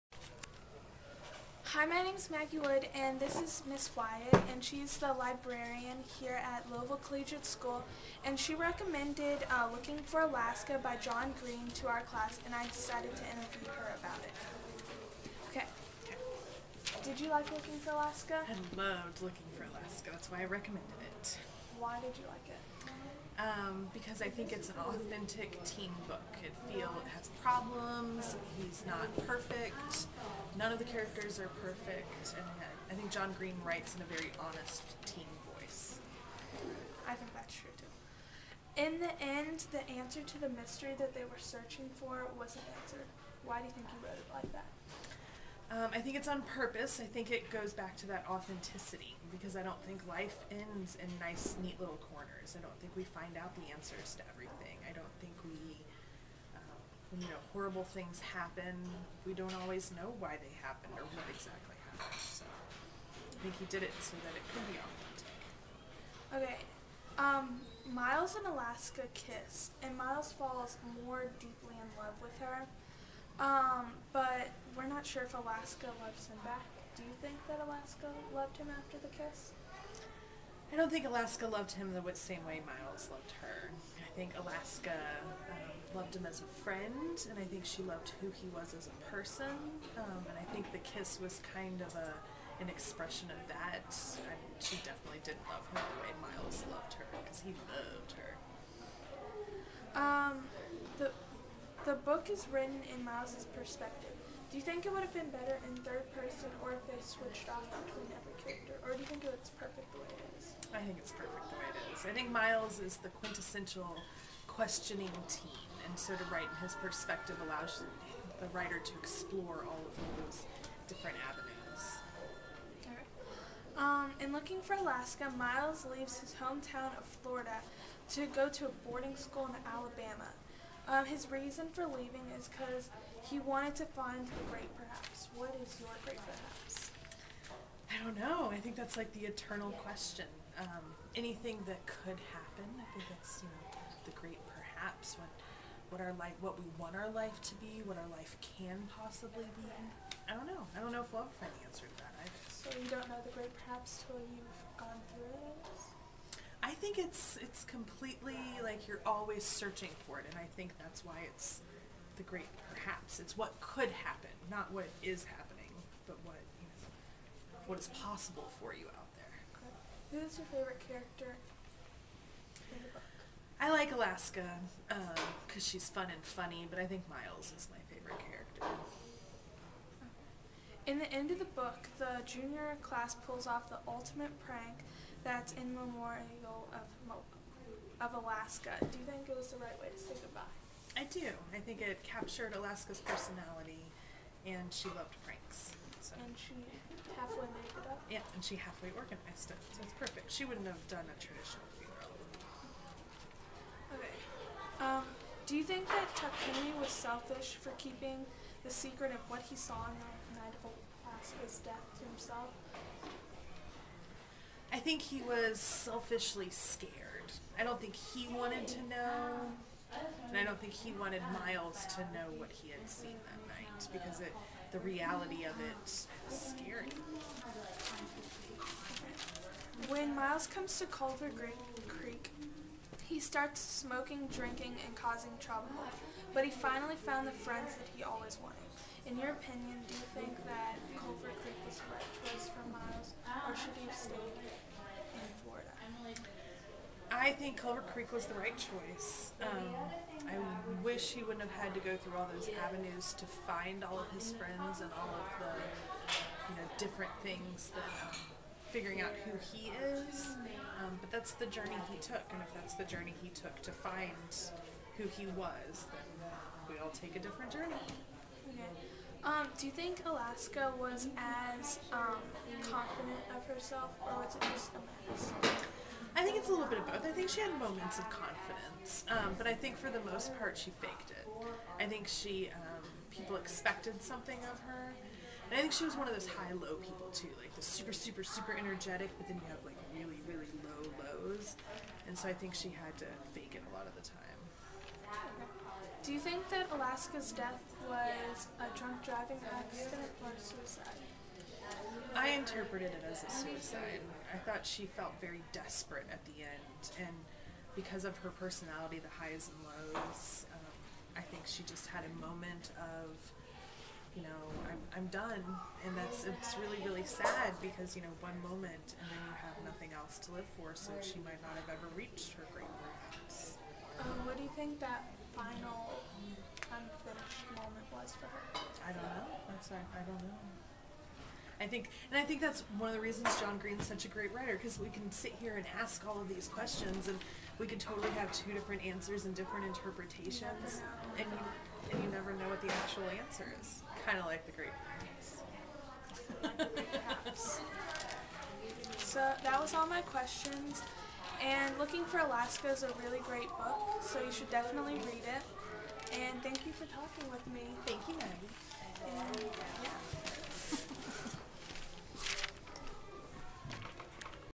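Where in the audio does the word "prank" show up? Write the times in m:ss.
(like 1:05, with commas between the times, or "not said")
3:04, 3:15.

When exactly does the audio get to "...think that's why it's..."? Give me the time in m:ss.
2:40.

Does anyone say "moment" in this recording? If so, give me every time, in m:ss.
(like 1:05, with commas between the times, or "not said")
4:37, 5:12, 5:18, 5:27.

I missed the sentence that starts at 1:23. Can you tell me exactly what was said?
I think Alaska um, loved him as a friend, and I think she loved who he was as a person.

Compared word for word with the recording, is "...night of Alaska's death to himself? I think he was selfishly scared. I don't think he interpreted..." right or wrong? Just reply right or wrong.
wrong.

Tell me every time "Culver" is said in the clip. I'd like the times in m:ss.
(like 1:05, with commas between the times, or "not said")
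3:50, 4:00, 4:07.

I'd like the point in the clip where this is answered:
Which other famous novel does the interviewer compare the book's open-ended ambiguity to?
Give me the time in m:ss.
5:44.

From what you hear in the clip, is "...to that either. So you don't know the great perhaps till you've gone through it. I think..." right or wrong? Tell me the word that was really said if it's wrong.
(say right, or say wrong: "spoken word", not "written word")
right.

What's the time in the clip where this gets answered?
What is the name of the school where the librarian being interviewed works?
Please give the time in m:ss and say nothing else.
0:06.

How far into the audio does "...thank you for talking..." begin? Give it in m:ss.
5:56.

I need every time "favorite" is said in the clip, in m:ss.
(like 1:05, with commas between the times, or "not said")
2:50, 2:57.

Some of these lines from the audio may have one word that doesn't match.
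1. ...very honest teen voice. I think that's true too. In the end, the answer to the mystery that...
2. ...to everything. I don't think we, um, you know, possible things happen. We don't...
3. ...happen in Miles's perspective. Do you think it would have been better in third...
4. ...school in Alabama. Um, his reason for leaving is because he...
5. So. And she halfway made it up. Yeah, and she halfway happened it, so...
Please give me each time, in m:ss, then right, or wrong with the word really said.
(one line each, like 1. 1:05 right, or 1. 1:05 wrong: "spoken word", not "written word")
1. 0:34 right
2. 0:54 wrong: "horrible", not "possible"
3. 1:42 wrong: "written", not "happen"
4. 2:09 right
5. 3:16 wrong: "organized", not "happened".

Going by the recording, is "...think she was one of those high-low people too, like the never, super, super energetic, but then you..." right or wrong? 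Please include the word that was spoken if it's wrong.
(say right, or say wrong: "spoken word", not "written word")
wrong: "super", not "never".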